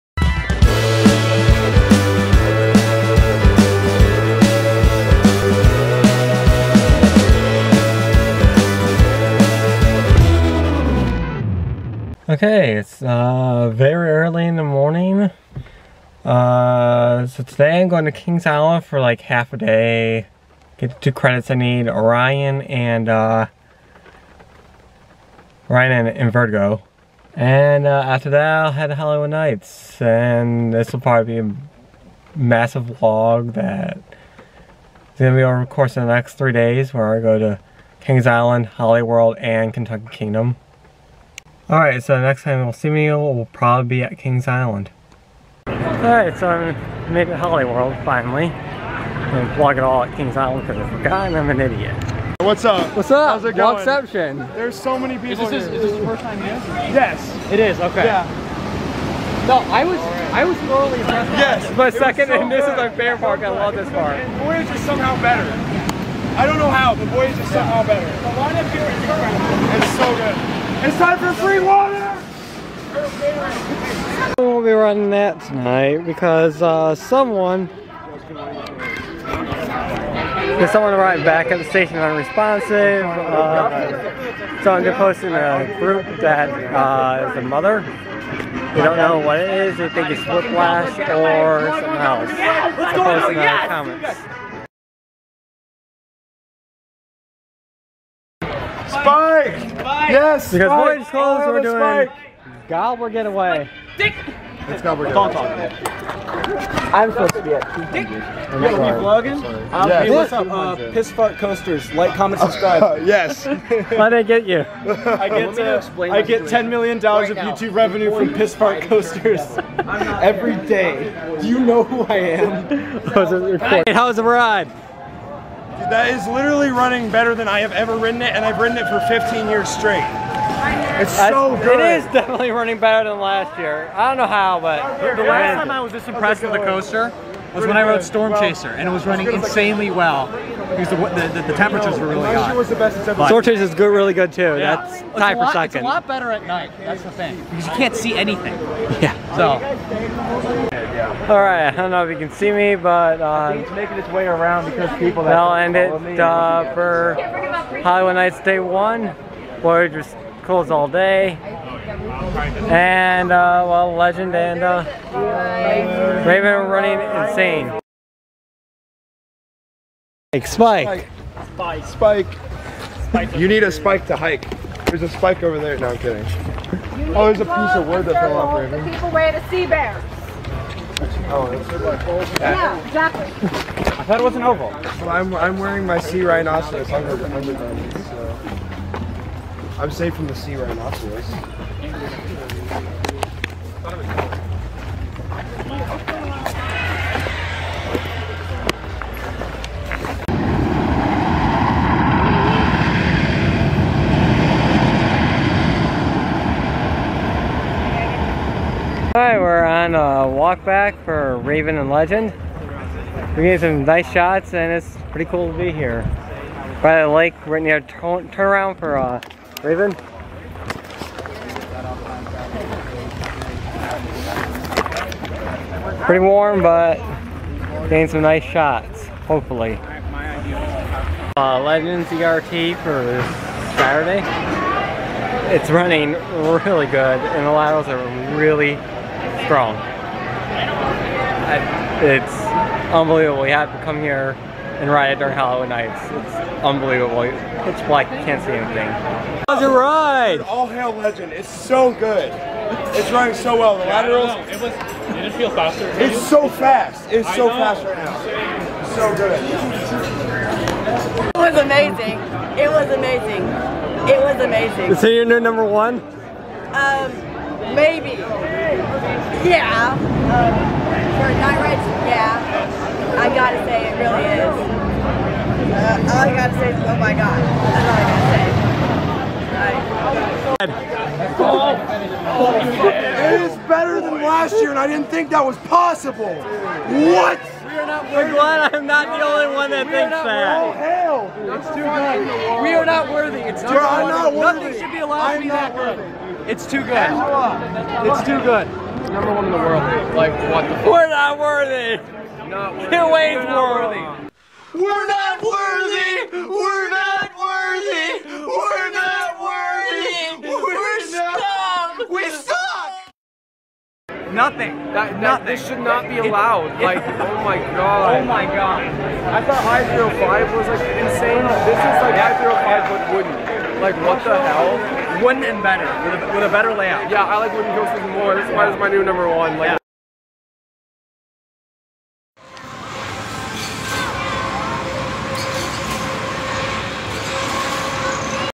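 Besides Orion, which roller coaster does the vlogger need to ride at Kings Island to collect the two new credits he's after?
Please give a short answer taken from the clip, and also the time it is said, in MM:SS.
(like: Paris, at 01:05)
Vertigo, at 00:26.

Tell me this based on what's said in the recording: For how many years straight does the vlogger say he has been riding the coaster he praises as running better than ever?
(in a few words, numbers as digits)
15.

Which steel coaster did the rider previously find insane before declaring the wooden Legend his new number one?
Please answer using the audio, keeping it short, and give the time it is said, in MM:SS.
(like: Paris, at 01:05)
I-305, at 05:19.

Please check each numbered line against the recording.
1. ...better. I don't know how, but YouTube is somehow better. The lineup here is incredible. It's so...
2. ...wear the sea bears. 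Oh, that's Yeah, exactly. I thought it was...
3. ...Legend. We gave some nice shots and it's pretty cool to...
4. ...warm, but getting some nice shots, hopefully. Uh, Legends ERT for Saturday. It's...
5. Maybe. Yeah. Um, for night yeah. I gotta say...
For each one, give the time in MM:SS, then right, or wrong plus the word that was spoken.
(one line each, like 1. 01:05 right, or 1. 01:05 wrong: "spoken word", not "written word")
1. 01:05 wrong: "Voyage", not "YouTube"
2. 02:59 right
3. 03:31 right
4. 03:46 right
5. 04:27 right.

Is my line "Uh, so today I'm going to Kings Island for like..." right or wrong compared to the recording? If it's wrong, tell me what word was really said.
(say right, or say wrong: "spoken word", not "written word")
right.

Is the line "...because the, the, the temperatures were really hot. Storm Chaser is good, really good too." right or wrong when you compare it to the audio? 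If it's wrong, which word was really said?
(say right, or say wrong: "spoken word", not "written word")
right.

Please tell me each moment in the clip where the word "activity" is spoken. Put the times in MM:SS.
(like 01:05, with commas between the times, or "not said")
not said.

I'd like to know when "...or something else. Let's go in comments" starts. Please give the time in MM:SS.
01:30.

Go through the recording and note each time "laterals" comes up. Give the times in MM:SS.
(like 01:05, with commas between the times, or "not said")
03:57, 04:13.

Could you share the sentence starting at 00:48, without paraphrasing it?
I'm gonna vlog it all at Kings Island because I forgot and I'm an idiot.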